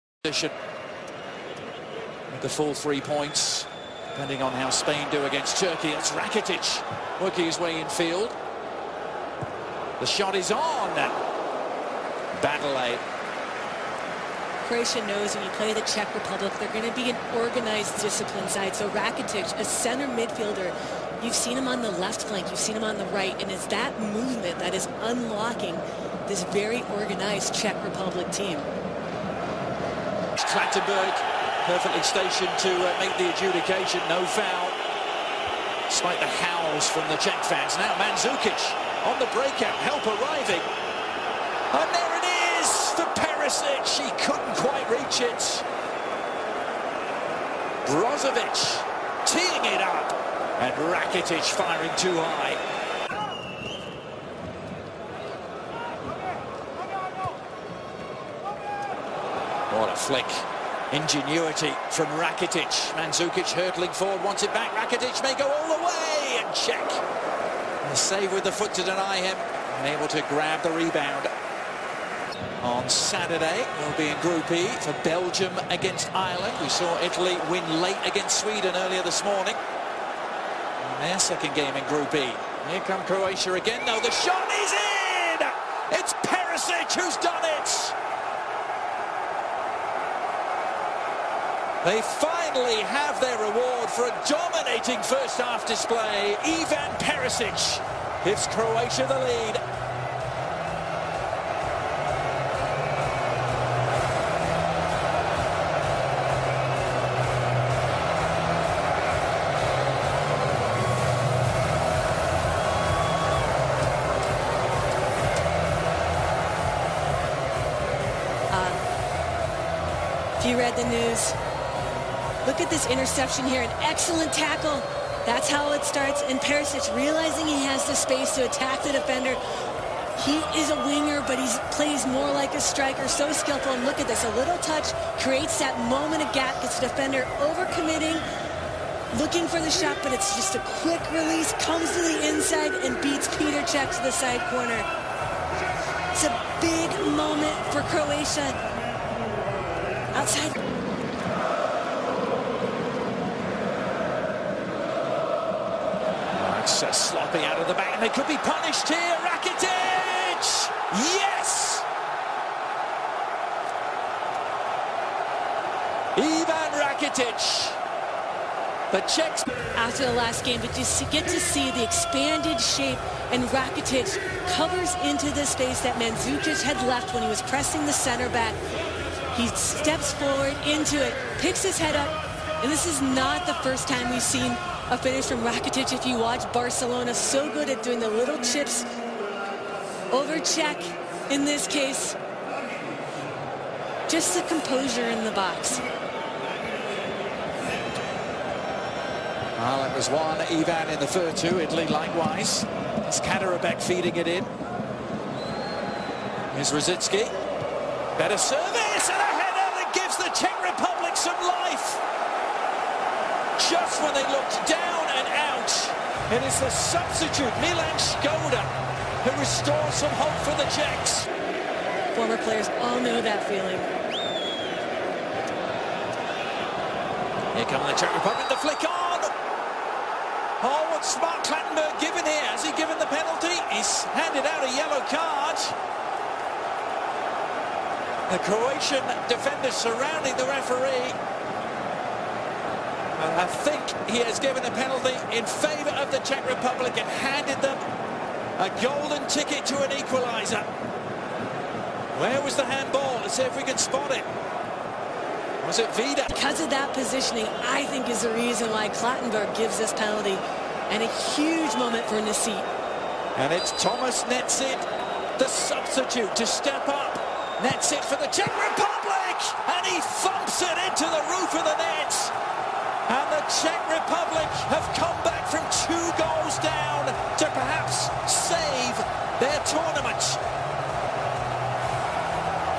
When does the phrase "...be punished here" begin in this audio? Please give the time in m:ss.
2:38.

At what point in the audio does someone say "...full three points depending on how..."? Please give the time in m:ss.
0:02.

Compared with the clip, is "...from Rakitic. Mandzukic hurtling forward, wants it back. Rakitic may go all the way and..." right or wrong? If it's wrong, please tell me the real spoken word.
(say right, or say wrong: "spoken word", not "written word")
right.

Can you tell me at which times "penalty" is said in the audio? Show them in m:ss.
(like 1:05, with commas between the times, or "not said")
3:53, 4:04, 4:19.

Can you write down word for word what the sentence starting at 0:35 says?
Despite the howls from the Czech fans.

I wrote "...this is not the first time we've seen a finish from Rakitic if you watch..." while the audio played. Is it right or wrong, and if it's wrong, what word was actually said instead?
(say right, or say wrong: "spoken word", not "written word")
right.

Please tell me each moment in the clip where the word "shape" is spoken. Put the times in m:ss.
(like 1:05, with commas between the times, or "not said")
2:52.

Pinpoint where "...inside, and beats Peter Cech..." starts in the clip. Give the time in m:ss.
2:22.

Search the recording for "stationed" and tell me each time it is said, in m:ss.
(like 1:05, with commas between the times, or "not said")
0:32.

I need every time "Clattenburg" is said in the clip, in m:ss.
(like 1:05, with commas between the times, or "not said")
0:30, 3:51, 4:18.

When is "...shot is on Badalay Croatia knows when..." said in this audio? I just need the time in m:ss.
0:10.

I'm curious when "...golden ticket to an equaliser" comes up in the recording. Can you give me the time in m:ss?
4:08.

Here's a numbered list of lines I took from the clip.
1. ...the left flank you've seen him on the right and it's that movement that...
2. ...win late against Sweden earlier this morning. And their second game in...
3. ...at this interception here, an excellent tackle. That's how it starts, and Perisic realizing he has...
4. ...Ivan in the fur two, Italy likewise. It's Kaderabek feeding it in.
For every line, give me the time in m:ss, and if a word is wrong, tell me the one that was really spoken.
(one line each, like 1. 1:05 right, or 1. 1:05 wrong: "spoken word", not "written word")
1. 0:21 right
2. 1:17 right
3. 2:02 right
4. 3:20 right.